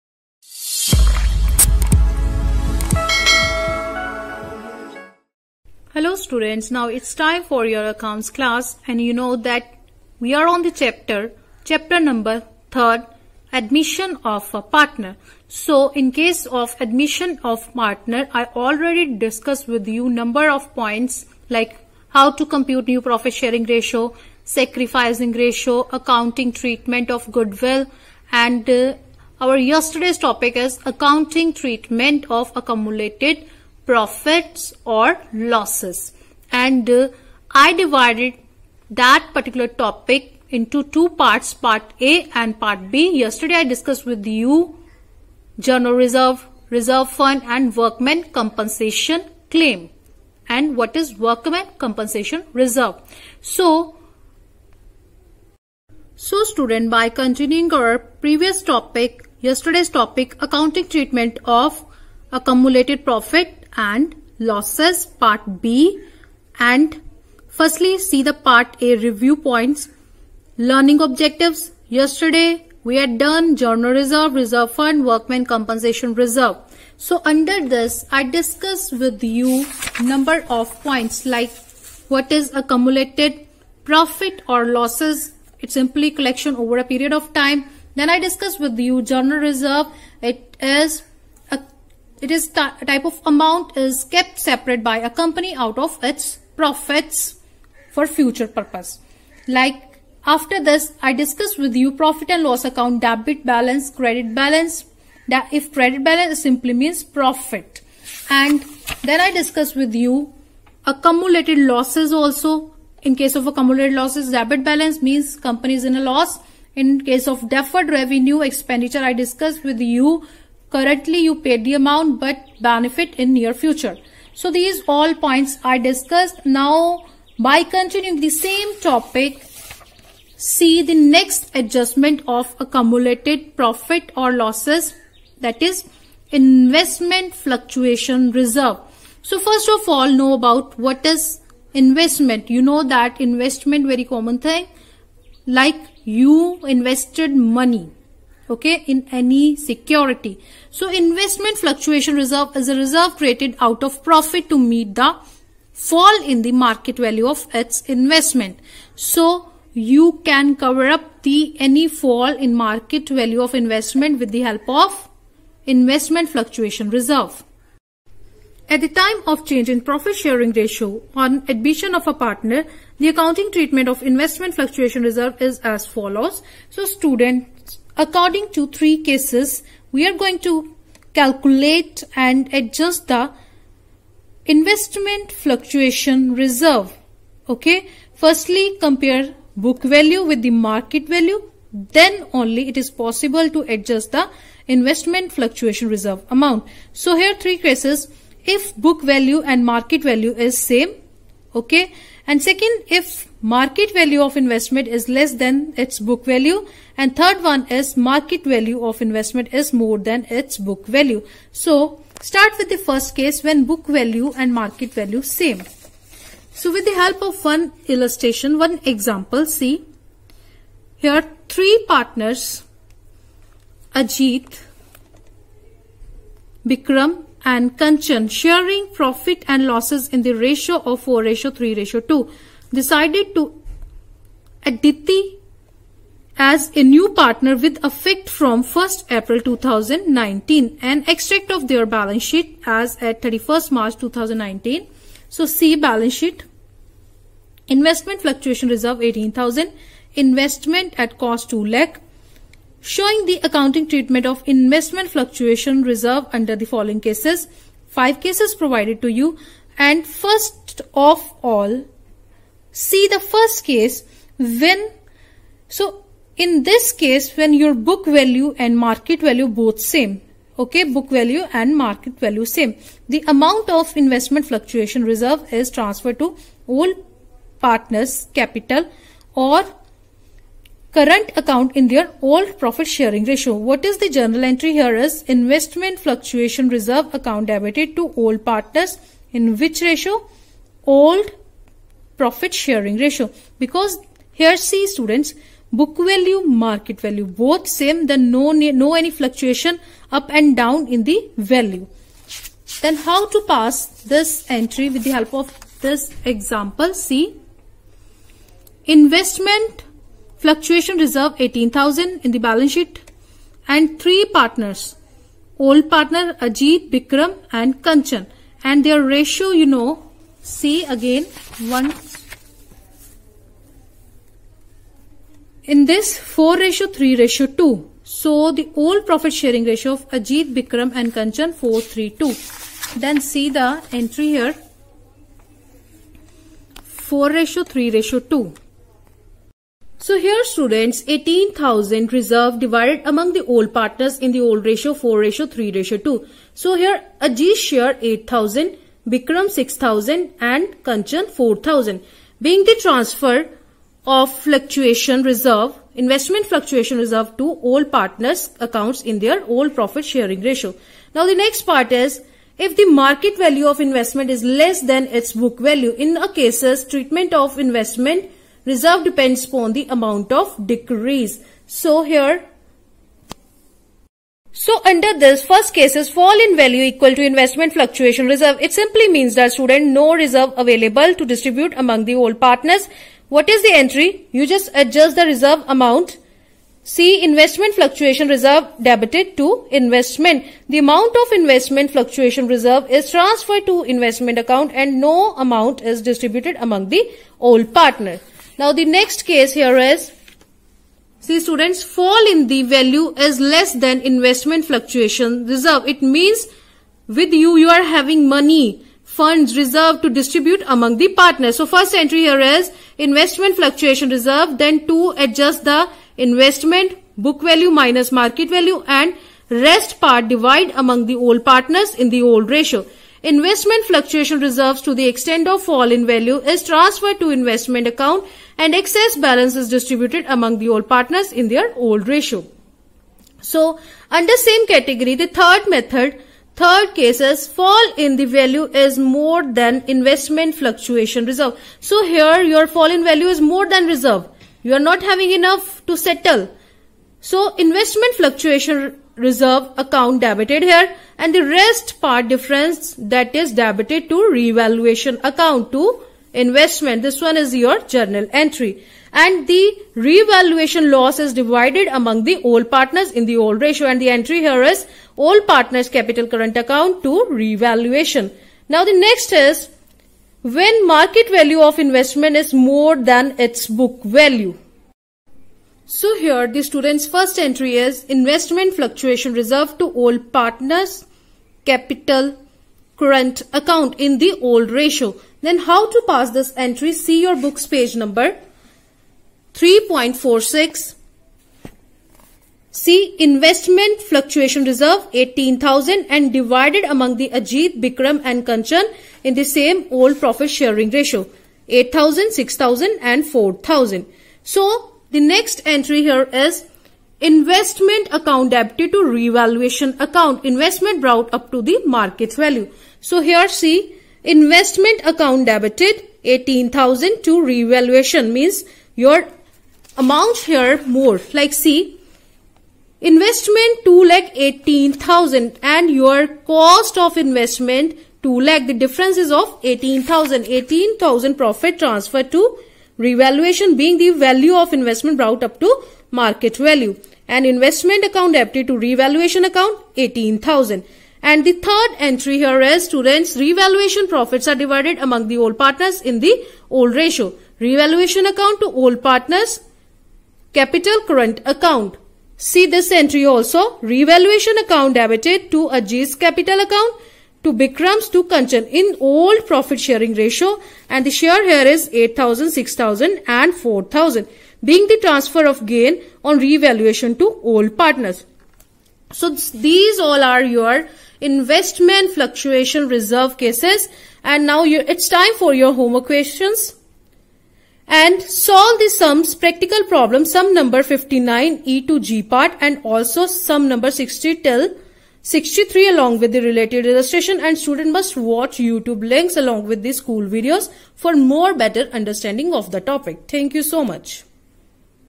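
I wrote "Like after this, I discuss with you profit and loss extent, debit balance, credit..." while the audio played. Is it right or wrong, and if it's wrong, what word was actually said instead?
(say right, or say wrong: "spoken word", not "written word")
wrong: "account", not "extent".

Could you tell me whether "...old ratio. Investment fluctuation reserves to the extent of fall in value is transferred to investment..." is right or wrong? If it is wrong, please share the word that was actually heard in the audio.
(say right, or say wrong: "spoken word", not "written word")
right.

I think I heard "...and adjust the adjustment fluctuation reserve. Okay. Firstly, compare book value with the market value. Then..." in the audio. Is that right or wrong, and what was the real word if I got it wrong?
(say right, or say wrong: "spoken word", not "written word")
wrong: "investment", not "adjustment".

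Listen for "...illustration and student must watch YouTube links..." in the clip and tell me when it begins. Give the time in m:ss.
9:46.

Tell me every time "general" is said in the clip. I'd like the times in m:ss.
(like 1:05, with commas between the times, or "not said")
0:45, 1:13, 1:29.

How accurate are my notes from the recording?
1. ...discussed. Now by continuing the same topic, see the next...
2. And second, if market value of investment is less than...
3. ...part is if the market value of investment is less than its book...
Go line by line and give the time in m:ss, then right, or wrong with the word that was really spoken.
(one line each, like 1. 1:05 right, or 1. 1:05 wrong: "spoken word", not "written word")
1. 2:05 right
2. 3:22 right
3. 6:01 right.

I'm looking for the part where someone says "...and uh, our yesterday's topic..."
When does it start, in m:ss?
0:28.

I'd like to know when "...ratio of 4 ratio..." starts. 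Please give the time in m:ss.
3:50.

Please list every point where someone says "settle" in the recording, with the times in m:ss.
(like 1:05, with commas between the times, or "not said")
7:25.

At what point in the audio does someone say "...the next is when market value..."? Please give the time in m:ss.
7:48.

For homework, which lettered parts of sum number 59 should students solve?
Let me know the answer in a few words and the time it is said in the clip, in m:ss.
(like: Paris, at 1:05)
E to G, at 9:40.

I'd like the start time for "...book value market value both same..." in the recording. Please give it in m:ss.
4:55.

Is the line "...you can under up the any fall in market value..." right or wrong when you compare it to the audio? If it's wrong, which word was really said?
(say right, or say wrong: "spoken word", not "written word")
wrong: "cover", not "under".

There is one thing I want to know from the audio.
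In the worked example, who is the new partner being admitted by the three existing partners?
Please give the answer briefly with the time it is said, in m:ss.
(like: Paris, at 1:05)
Aditi, at 3:54.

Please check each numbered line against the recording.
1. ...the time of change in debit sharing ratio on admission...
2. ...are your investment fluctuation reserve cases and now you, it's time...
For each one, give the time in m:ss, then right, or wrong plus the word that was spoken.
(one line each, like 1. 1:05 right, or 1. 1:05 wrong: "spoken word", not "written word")
1. 2:48 wrong: "profit", not "debit"
2. 9:30 right.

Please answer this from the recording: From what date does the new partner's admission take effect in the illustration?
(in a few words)
1st April 2019.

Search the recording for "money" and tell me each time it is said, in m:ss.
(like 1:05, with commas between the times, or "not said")
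2:27, 6:48.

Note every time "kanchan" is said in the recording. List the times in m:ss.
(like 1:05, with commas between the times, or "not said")
3:47, 5:17, 5:31, 5:50, 8:18, 9:18.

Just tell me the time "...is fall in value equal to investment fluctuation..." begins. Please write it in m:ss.
6:15.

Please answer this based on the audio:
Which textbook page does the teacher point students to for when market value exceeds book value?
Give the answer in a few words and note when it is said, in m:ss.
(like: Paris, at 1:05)
3.46, at 8:09.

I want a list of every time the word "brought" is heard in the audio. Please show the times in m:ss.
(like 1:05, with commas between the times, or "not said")
8:31, 8:55.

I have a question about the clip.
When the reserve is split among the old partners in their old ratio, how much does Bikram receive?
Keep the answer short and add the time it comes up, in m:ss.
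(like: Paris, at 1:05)
6000, at 5:49.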